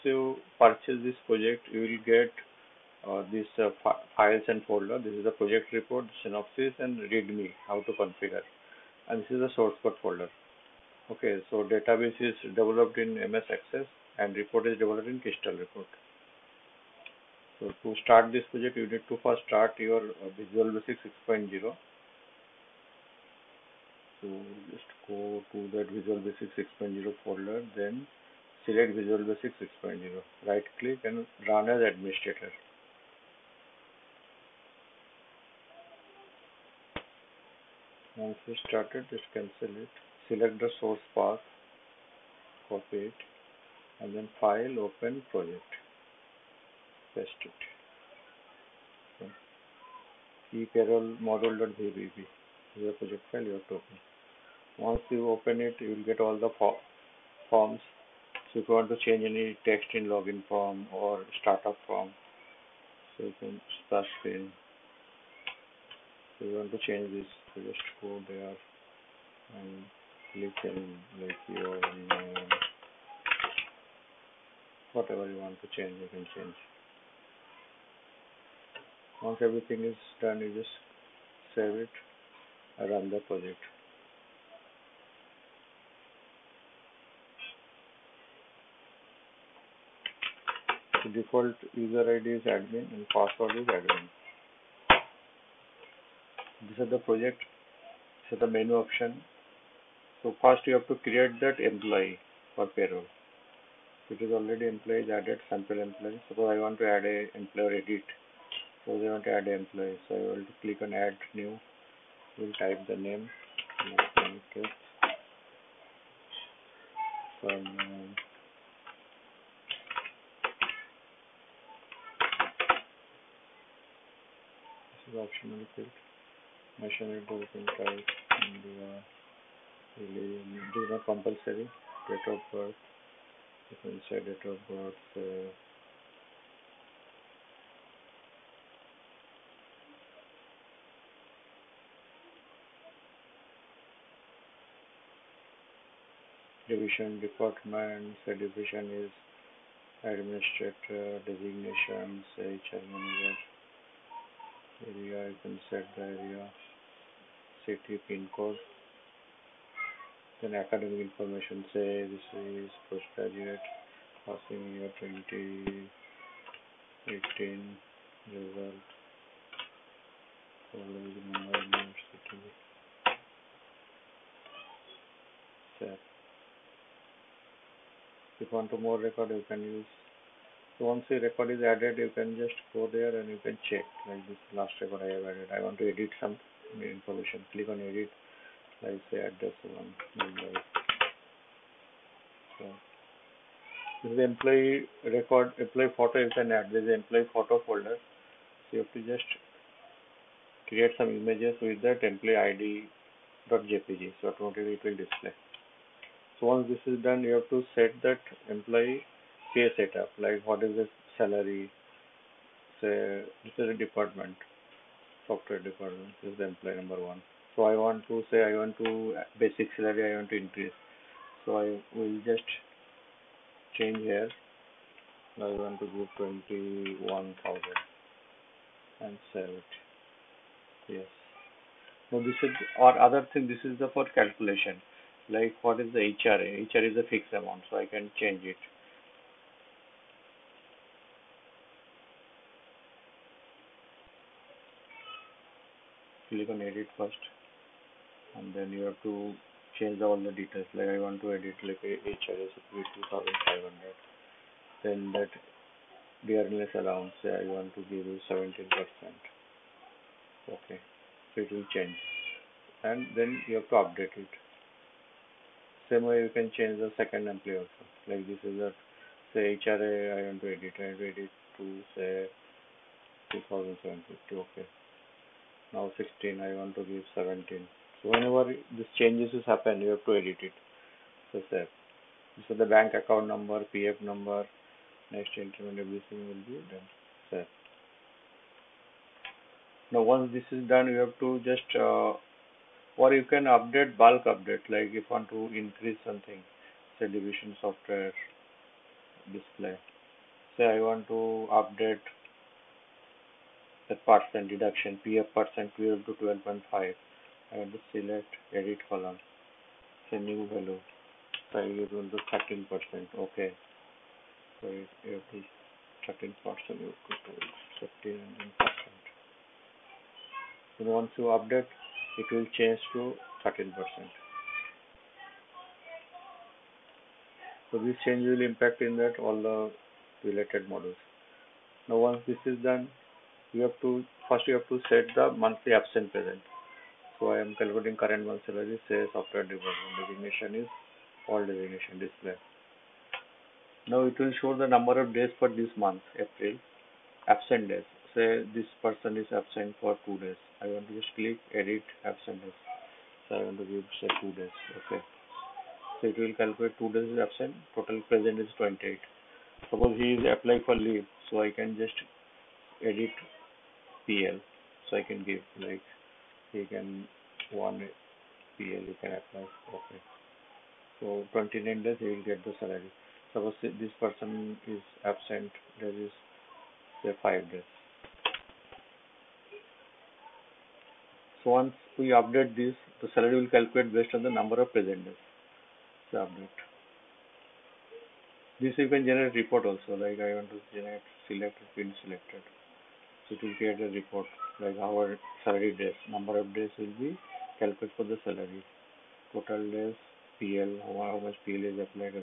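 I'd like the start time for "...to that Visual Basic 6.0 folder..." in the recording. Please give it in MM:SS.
00:25.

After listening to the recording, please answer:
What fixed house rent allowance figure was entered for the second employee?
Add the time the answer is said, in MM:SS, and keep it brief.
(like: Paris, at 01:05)
2750, at 04:33.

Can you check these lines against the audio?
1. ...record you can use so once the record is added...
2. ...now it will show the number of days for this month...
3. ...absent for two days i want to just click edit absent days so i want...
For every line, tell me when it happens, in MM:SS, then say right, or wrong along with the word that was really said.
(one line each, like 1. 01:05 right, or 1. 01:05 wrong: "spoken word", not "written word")
1. 02:58 right
2. 05:43 right
3. 05:49 right.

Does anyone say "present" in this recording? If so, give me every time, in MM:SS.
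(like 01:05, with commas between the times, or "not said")
05:36, 05:58, 06:24.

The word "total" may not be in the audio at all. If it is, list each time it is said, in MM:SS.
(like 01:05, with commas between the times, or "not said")
05:57, 06:39.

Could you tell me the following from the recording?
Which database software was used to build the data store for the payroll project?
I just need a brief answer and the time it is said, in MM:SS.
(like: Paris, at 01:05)
MS Access, at 00:13.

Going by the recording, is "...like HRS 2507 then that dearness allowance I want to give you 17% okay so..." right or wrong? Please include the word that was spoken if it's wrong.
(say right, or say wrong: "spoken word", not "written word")
wrong: "2500", not "2507".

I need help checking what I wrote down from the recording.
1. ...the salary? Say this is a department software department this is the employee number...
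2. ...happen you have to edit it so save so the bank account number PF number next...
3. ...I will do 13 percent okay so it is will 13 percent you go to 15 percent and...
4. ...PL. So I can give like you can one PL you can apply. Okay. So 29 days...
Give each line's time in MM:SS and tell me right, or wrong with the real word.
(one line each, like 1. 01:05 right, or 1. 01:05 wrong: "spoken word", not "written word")
1. 03:30 right
2. 04:39 right
3. 05:11 right
4. 06:04 right.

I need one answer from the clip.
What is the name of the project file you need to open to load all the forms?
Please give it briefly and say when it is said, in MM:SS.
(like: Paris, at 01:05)
ePayroll model.vbp, at 00:50.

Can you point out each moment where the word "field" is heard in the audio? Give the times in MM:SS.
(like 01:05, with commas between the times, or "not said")
02:05, 06:31.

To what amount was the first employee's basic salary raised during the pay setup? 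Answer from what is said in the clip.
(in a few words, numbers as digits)
21000.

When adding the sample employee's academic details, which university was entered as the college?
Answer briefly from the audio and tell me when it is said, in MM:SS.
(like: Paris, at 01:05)
Mumbai University, at 02:51.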